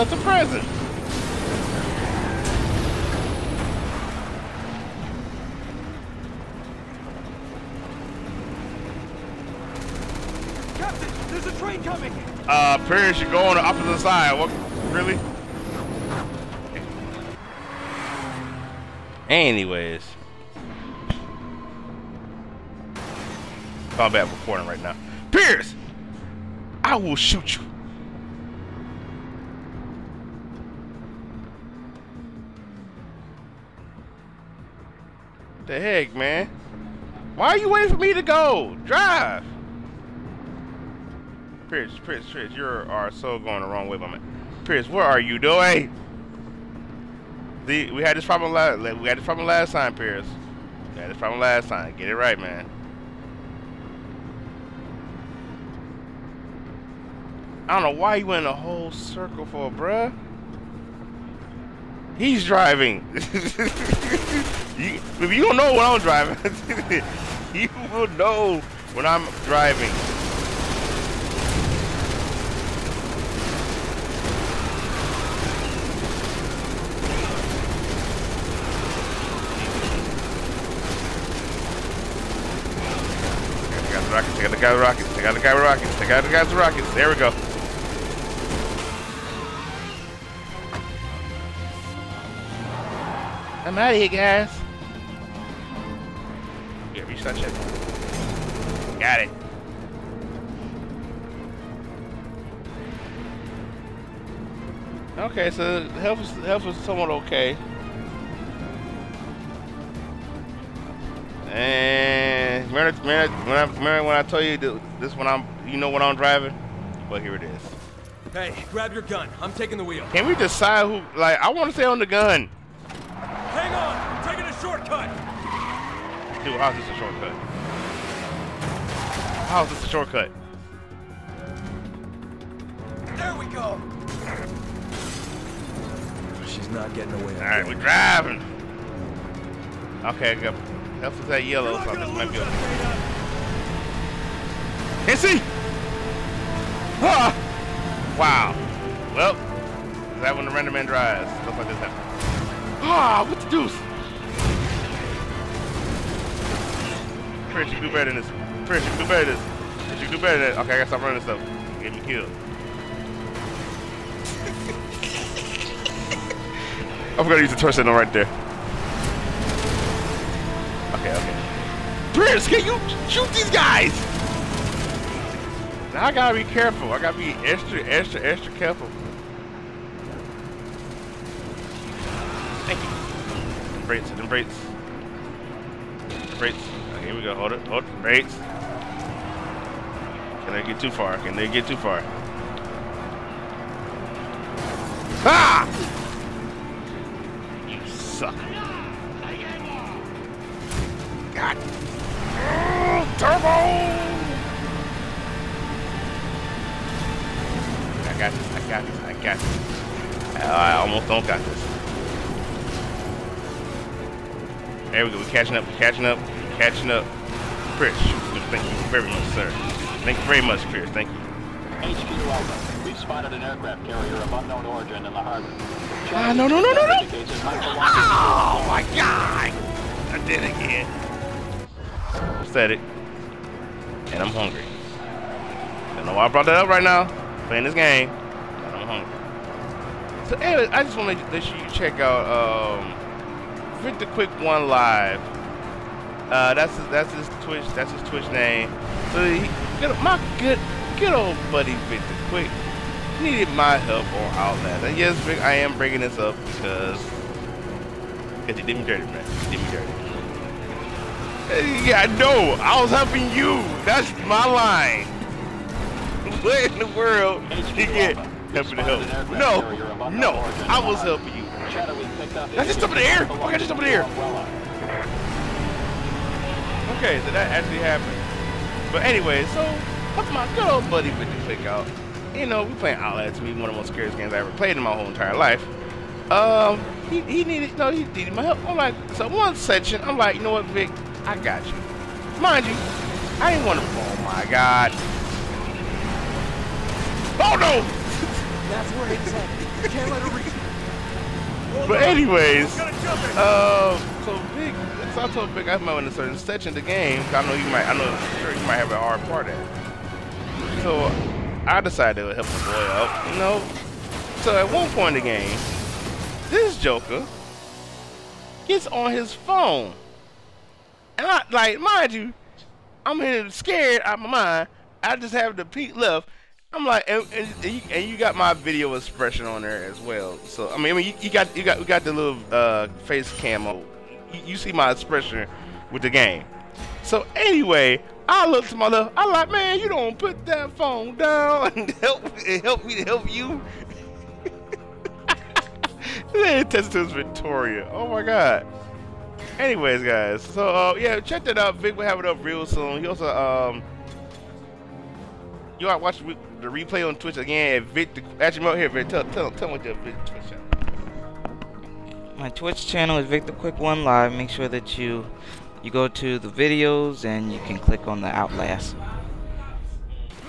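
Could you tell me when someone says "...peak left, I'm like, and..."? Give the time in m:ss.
5:25.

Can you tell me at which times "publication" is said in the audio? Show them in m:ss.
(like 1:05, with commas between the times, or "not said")
not said.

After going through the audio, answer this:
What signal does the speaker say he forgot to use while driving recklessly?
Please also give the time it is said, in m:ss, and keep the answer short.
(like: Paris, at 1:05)
Torch signal, at 2:47.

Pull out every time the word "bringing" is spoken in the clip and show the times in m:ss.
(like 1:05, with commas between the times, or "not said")
4:15.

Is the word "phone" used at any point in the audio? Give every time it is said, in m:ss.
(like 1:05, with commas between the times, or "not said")
5:19, 5:40.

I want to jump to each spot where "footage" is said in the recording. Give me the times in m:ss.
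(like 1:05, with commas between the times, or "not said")
not said.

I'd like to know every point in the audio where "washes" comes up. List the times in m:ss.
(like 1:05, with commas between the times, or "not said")
not said.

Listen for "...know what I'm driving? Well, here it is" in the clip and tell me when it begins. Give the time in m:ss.
1:55.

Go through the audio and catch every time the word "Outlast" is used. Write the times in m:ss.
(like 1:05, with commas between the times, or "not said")
4:14, 4:42, 6:08.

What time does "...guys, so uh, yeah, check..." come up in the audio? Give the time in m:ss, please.
5:50.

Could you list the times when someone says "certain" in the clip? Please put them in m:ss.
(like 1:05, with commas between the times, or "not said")
5:06.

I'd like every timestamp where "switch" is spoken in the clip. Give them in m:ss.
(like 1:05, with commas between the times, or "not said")
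not said.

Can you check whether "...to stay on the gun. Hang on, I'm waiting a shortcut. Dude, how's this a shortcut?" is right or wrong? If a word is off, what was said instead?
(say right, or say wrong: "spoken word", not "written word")
wrong: "taking", not "waiting".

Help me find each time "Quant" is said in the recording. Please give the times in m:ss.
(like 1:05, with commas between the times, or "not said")
not said.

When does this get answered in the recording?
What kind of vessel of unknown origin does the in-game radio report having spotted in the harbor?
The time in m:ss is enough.
3:43.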